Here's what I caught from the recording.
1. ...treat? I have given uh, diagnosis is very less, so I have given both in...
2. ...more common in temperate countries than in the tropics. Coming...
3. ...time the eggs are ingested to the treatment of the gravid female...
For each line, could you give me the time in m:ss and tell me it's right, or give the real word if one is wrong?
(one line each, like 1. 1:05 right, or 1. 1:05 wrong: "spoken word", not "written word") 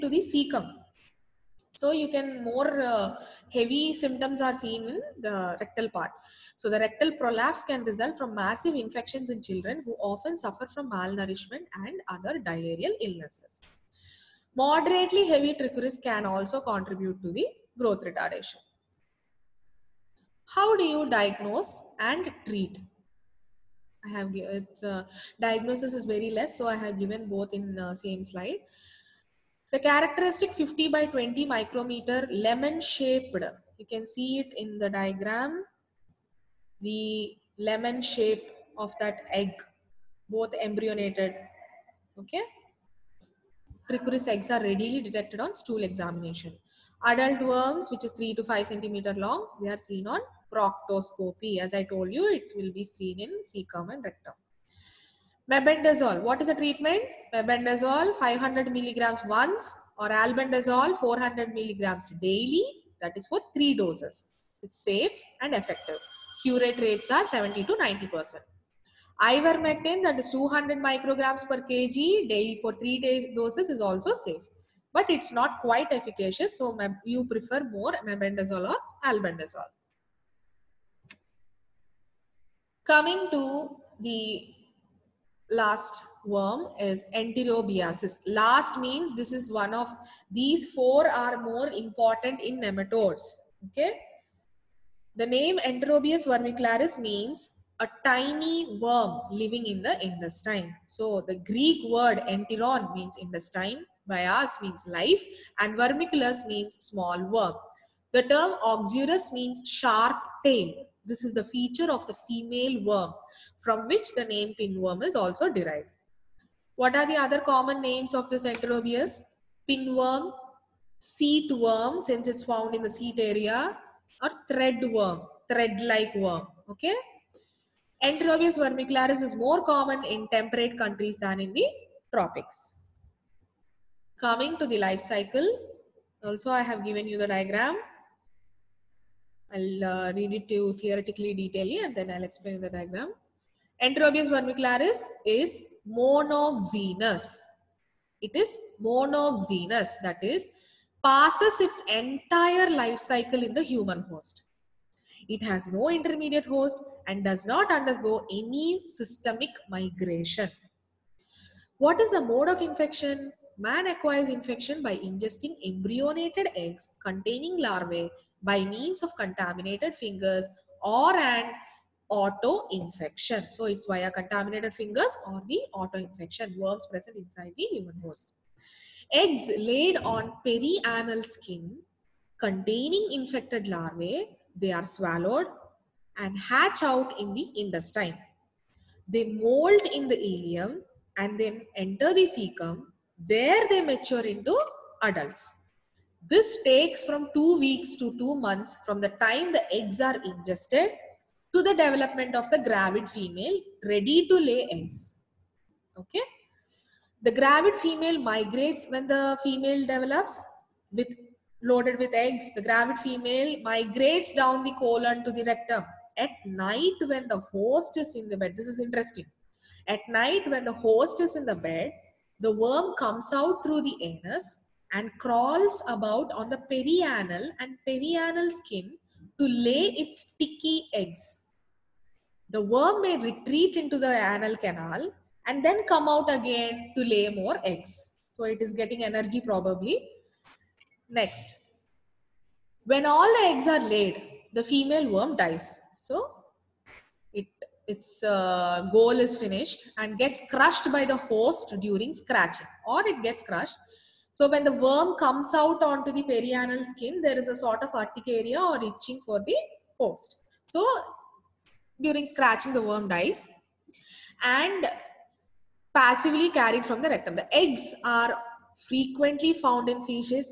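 1. 0:22 right
2. 2:09 right
3. 3:19 wrong: "development", not "treatment".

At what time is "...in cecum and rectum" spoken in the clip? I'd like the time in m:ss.
0:53.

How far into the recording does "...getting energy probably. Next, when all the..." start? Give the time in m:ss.
3:58.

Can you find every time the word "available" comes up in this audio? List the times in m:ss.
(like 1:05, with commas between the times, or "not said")
not said.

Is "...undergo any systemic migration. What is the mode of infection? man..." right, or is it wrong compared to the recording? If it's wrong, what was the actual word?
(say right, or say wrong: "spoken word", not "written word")
right.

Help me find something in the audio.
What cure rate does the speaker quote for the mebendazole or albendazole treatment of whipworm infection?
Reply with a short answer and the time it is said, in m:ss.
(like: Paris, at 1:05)
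70 to 90 percent, at 1:07.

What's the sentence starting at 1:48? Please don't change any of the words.
The term oxurus means sharp tail.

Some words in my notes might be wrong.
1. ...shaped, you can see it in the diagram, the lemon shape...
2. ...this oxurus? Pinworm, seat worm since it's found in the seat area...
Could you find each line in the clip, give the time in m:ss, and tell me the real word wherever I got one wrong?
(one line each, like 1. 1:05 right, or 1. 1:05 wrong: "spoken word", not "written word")
1. 0:32 right
2. 1:58 wrong: "enterobius", not "oxurus".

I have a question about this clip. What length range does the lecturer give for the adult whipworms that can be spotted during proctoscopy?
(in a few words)
3 to 5 centimeters.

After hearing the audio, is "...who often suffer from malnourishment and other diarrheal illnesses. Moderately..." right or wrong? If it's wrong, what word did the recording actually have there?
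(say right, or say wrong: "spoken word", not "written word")
right.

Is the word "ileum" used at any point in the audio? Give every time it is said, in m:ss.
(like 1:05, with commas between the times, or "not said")
3:10.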